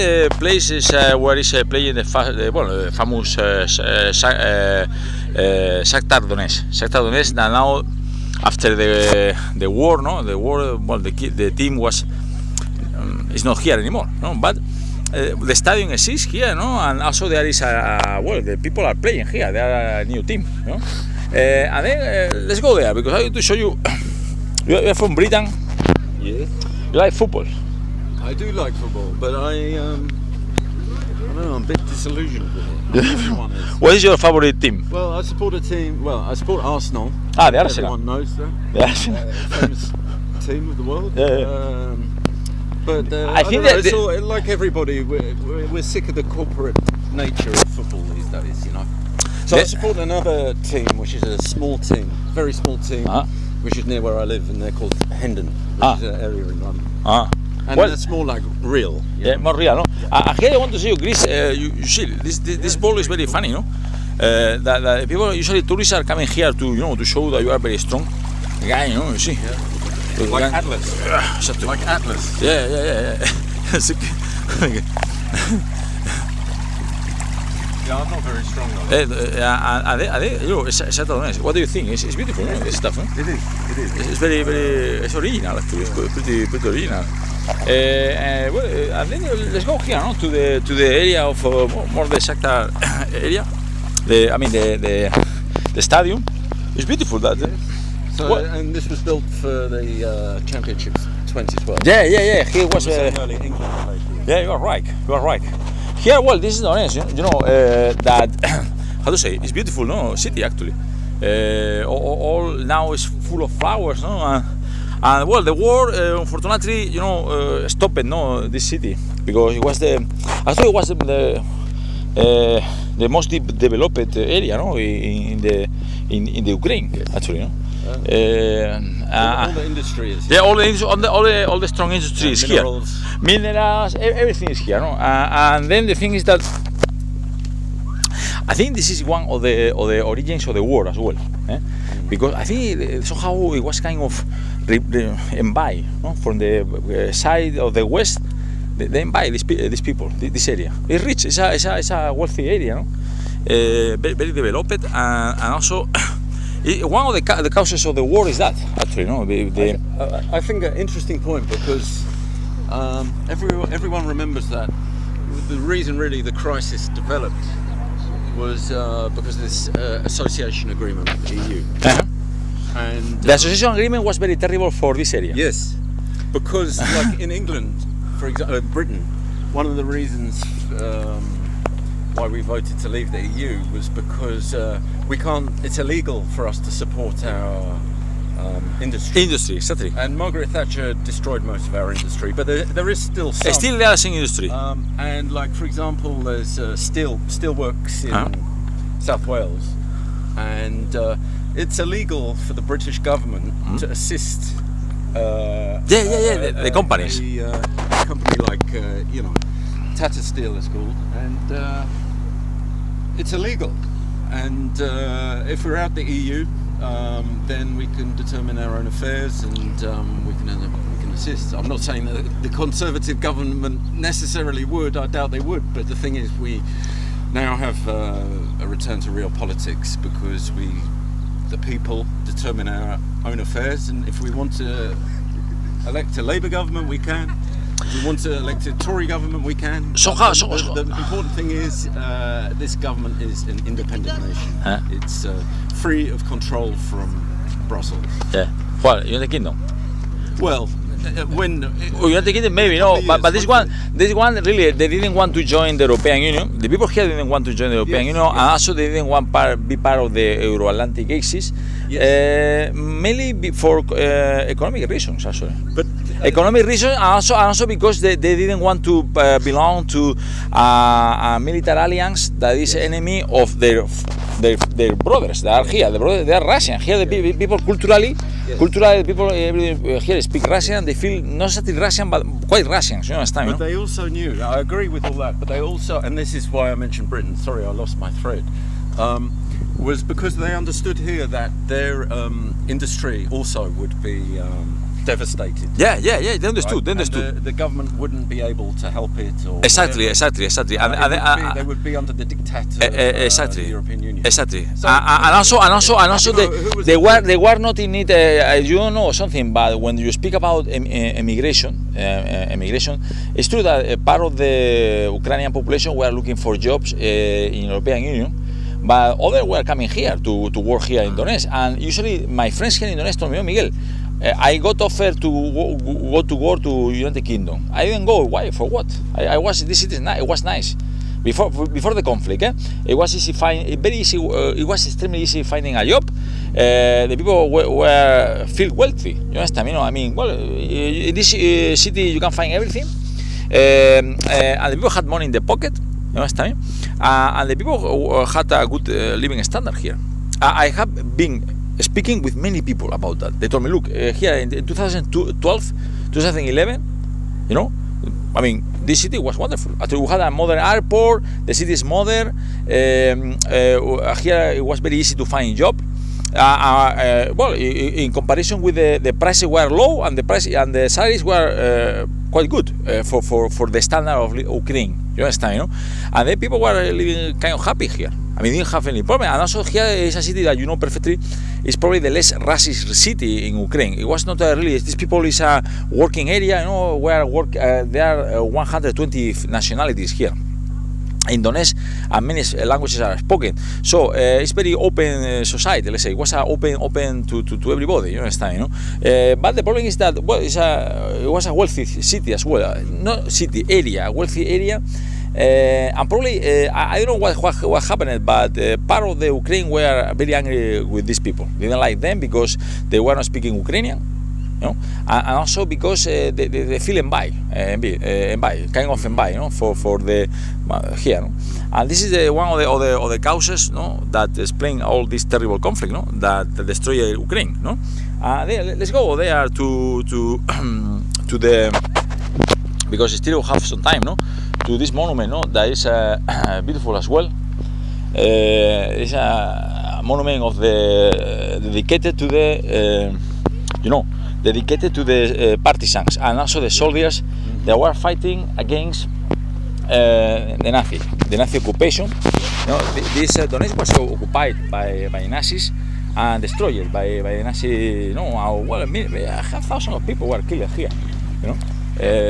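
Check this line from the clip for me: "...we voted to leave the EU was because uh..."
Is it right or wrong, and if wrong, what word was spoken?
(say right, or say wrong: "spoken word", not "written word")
right.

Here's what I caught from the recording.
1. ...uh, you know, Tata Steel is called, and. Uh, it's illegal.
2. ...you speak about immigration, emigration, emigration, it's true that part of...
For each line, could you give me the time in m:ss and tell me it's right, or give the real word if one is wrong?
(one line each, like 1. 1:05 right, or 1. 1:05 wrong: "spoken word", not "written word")
1. 3:28 right
2. 5:10 right.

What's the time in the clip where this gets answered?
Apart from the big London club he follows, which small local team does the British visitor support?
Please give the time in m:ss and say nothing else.
0:55.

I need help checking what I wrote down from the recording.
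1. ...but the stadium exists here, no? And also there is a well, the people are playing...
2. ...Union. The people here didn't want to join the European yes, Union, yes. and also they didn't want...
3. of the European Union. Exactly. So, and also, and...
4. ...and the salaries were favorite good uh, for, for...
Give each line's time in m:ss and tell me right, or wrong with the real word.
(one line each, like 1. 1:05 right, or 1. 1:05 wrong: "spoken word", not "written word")
1. 0:14 right
2. 4:16 right
3. 5:03 right
4. 6:10 wrong: "quite", not "favorite".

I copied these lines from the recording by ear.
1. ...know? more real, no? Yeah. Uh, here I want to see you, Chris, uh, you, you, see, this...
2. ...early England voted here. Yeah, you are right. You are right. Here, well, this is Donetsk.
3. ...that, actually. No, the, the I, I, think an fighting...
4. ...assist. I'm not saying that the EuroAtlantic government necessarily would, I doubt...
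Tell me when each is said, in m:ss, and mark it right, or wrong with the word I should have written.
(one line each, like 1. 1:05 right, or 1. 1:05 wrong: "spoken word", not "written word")
1. 0:59 right
2. 1:43 wrong: "played", not "voted"
3. 2:38 wrong: "interesting", not "fighting"
4. 3:41 wrong: "Conservative", not "EuroAtlantic".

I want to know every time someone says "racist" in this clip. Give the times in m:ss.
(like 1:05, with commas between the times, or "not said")
6:22.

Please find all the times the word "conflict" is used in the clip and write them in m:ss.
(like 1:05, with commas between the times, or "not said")
5:32, 7:05.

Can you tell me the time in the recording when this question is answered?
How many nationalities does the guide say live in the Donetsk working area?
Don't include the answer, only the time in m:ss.
6:28.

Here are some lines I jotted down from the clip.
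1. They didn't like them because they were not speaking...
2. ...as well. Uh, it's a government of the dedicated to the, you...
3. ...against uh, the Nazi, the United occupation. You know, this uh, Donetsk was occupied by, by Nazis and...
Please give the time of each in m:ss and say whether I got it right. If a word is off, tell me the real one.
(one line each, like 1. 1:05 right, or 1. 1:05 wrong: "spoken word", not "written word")
1. 6:51 right
2. 7:16 wrong: "monument", not "government"
3. 7:28 wrong: "Nazi", not "United".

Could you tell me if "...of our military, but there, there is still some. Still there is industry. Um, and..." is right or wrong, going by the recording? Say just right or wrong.
wrong.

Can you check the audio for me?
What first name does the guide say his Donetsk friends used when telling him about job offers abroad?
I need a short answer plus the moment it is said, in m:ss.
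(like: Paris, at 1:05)
Miguel, at 5:23.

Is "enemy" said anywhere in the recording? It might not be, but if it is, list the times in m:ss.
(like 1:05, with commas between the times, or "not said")
4:32.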